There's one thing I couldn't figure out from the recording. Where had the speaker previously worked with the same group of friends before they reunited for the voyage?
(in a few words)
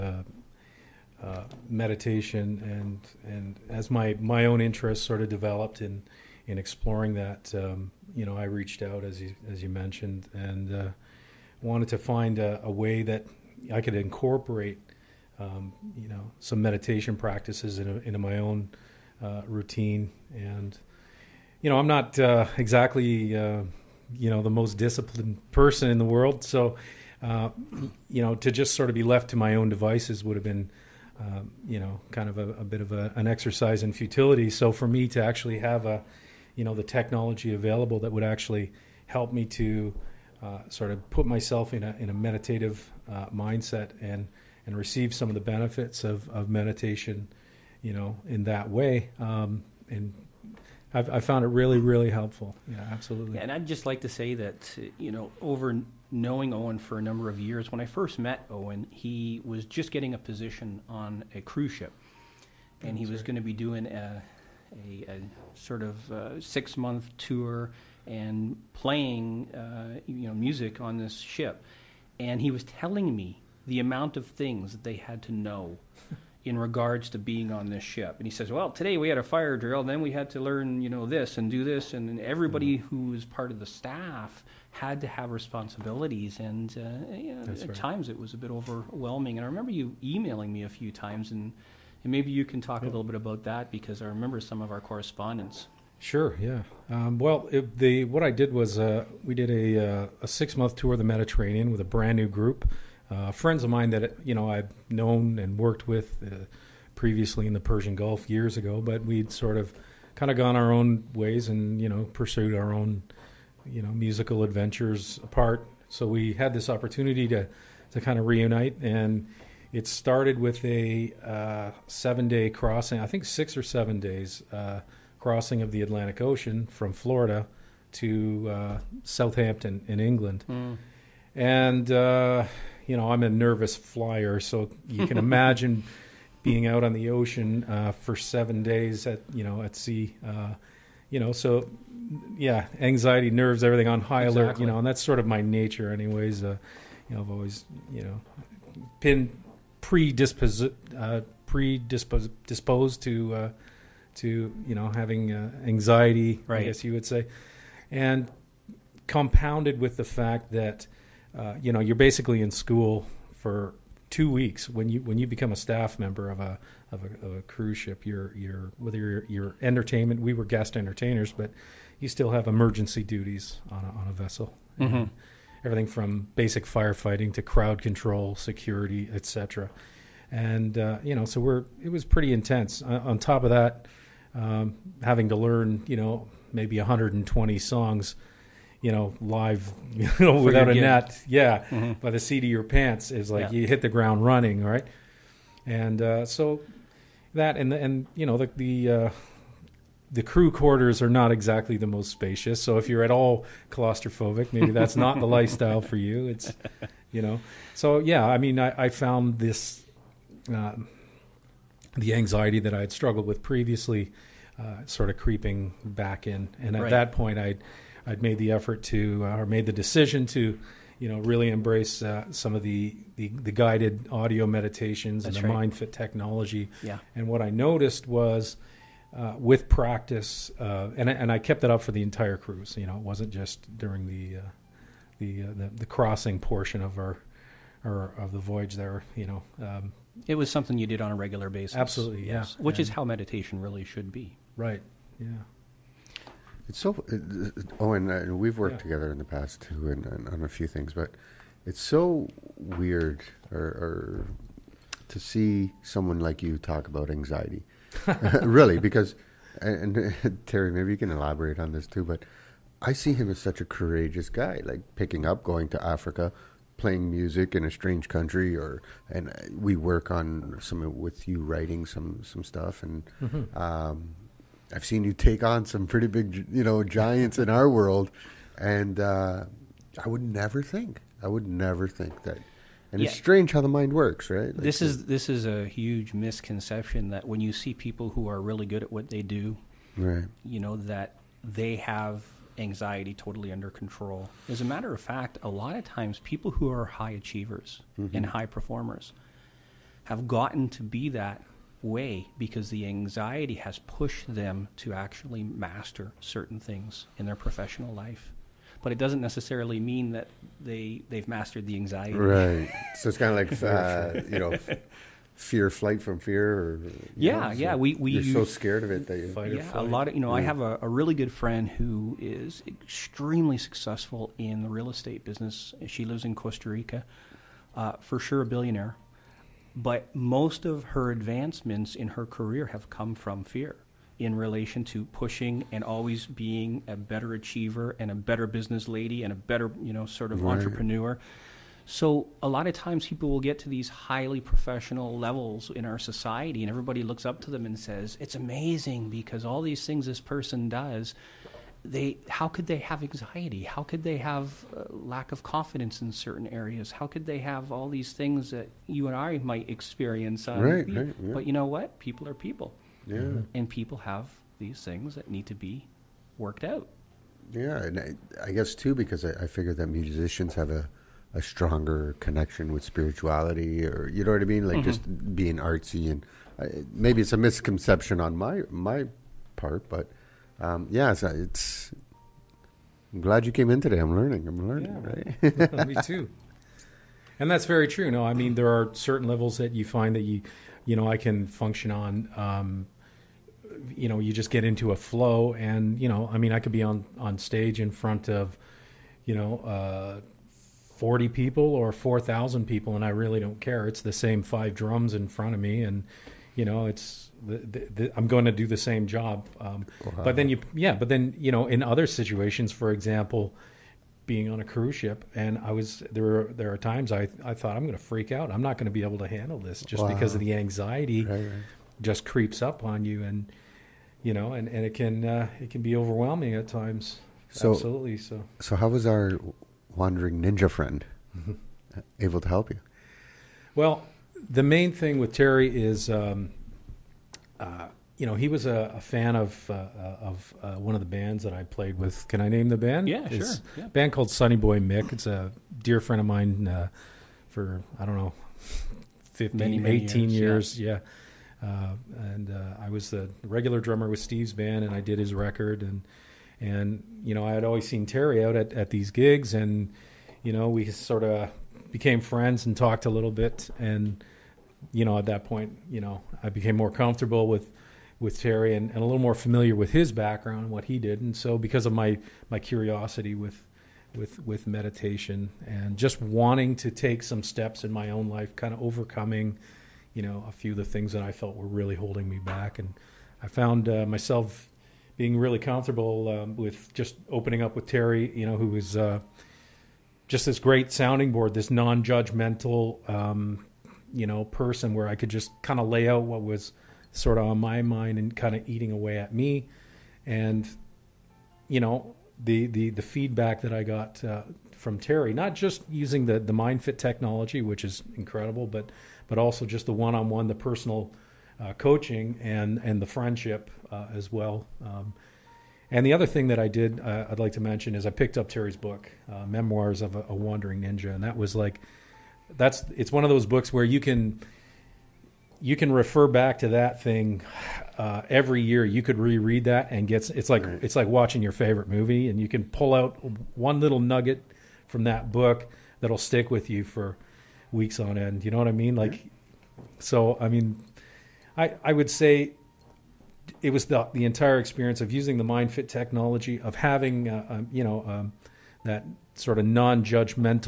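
Persian Gulf.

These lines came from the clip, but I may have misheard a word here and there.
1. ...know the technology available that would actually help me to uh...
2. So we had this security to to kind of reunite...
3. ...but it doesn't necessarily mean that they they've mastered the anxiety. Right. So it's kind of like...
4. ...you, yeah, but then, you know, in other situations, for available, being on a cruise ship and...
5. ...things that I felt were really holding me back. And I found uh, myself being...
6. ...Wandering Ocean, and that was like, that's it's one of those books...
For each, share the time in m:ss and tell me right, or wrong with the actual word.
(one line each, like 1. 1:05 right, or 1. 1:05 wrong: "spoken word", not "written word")
1. 0:36 right
2. 1:55 wrong: "opportunity", not "security"
3. 5:08 right
4. 6:50 wrong: "example", not "available"
5. 8:00 right
6. 8:40 wrong: "Ninja", not "Ocean".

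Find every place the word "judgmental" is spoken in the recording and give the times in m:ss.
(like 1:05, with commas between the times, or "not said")
8:12, 9:09.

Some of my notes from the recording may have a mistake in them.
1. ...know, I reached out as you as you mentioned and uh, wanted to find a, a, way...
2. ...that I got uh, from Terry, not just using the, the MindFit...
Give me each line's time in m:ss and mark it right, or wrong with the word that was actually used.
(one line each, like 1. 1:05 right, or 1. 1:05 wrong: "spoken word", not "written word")
1. 0:08 right
2. 8:23 right.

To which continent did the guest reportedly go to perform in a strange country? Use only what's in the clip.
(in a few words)
Africa.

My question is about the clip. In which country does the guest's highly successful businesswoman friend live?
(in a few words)
Costa Rica.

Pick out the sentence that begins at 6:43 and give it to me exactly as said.
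It's the same five drums in front of me.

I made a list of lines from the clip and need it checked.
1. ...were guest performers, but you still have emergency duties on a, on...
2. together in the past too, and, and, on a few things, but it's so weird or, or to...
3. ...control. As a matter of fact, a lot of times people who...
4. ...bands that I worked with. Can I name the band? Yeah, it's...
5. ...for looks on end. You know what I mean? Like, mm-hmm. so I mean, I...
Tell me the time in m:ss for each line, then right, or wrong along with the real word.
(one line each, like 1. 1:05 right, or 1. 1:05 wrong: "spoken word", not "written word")
1. 2:50 wrong: "entertainers", not "performers"
2. 4:08 right
3. 4:53 right
4. 7:21 wrong: "played", not "worked"
5. 8:56 wrong: "weeks", not "looks".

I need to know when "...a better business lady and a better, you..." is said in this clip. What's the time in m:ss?
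5:38.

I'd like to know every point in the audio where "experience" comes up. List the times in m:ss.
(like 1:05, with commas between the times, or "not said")
5:59, 9:04.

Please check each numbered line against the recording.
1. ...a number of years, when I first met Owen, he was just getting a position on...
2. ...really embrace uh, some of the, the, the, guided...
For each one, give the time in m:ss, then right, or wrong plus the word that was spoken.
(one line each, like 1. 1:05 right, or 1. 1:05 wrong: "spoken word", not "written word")
1. 0:56 right
2. 3:41 right.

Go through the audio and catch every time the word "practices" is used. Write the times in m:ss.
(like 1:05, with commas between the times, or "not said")
0:17, 3:49.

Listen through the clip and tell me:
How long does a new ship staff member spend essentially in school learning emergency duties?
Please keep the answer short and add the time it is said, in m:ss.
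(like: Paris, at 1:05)
2 weeks, at 2:44.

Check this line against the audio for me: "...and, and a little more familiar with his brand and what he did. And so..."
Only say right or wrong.
wrong.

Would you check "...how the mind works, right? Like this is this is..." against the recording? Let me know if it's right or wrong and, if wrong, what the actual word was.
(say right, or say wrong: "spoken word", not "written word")
right.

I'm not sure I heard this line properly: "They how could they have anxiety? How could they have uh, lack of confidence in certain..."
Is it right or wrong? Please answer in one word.
right.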